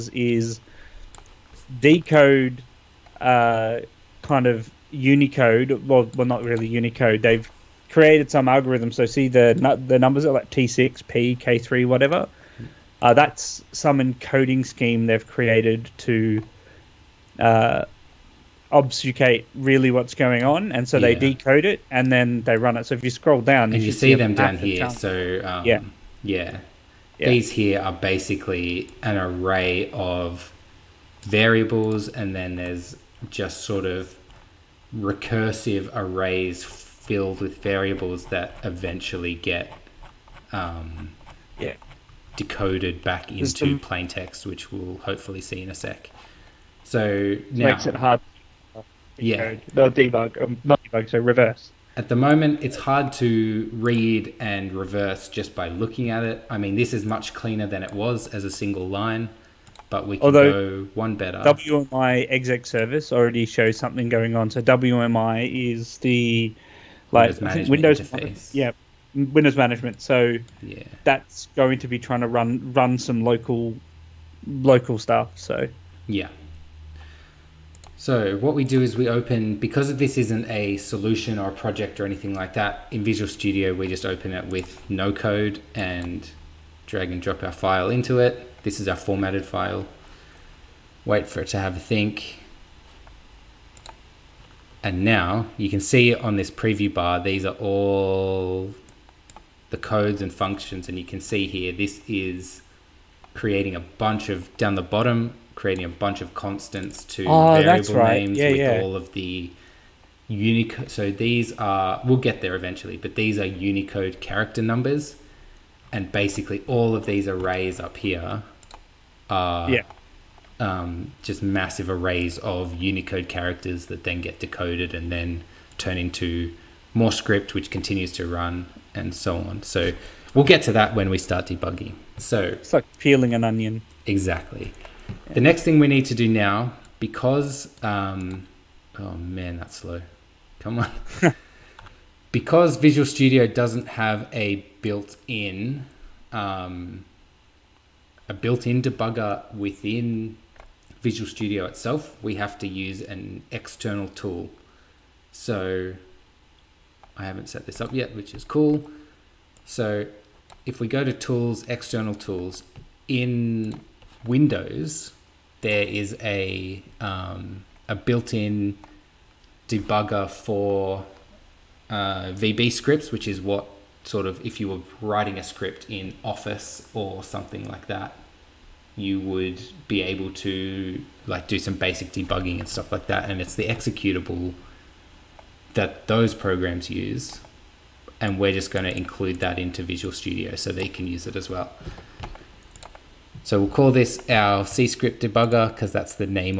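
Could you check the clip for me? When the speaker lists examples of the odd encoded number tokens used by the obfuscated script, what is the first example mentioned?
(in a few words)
T6.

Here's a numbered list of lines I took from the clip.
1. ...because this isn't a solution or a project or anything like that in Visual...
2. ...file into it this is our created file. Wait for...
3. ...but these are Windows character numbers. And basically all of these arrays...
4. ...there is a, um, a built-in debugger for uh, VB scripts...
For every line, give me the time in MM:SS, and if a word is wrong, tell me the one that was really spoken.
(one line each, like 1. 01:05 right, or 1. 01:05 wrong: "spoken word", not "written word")
1. 01:19 right
2. 01:27 wrong: "formatted", not "created"
3. 01:52 wrong: "Unicode", not "Windows"
4. 02:45 right.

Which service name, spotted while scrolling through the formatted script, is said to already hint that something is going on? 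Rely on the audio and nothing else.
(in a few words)
WMI exec service.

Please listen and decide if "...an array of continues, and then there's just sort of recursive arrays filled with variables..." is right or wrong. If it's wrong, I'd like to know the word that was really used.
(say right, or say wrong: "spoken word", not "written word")
wrong: "variables", not "continues".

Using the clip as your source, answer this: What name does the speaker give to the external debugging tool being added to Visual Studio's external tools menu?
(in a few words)
C script debugger.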